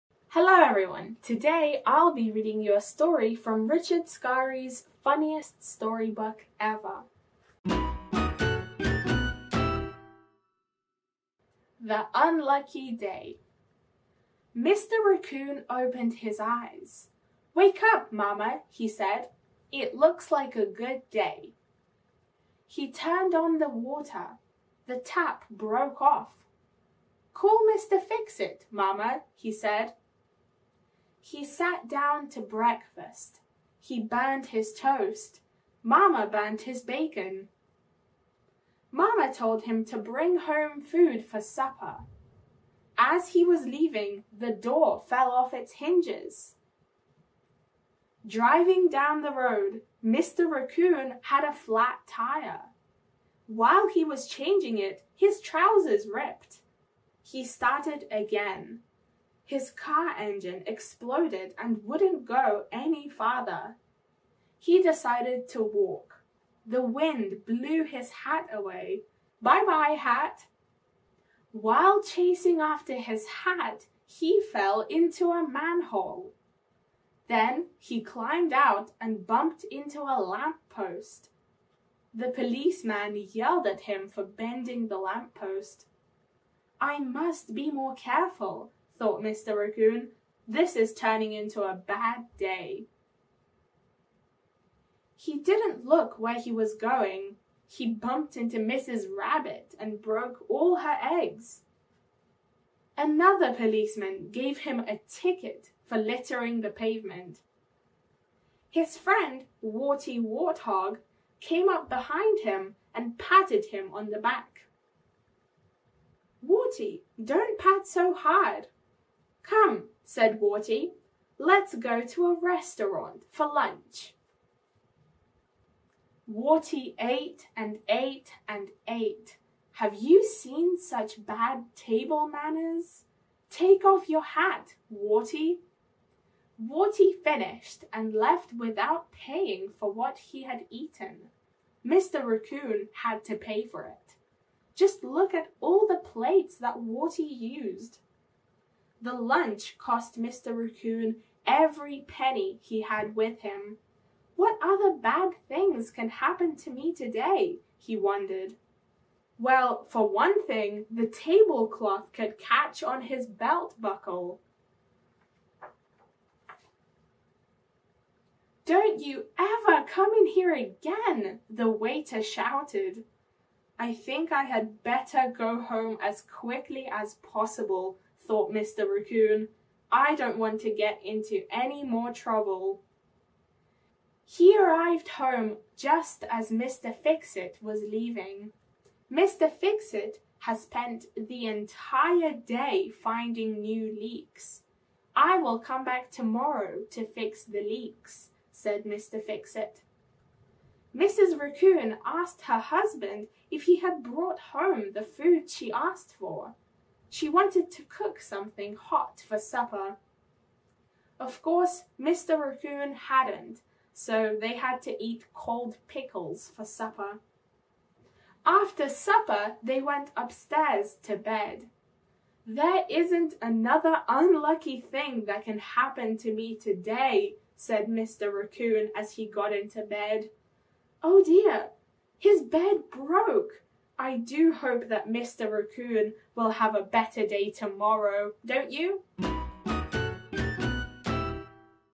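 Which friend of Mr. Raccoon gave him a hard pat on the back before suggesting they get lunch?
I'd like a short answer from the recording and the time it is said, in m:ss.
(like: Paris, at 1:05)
Warty Warthog, at 1:49.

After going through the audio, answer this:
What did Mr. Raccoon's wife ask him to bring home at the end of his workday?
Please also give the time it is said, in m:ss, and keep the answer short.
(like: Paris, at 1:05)
Food for supper, at 0:40.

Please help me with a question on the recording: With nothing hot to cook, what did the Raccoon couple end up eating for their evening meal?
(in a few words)
Cold pickles.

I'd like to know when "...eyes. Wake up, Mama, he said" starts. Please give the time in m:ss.
0:16.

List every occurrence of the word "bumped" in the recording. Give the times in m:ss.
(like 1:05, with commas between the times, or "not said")
1:19, 1:37.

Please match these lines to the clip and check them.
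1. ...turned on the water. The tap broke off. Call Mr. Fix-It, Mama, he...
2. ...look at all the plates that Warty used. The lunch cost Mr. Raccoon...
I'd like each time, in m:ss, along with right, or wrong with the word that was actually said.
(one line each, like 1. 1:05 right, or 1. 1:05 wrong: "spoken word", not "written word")
1. 0:22 right
2. 2:25 right.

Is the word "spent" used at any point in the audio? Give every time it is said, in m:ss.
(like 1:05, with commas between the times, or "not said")
3:10.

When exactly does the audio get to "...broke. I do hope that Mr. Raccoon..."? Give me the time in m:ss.
3:52.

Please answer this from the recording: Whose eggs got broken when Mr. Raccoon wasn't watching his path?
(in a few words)
Mrs. Rabbit.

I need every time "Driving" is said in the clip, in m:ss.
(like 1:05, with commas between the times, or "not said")
0:48.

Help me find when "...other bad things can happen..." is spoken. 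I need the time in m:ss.
2:34.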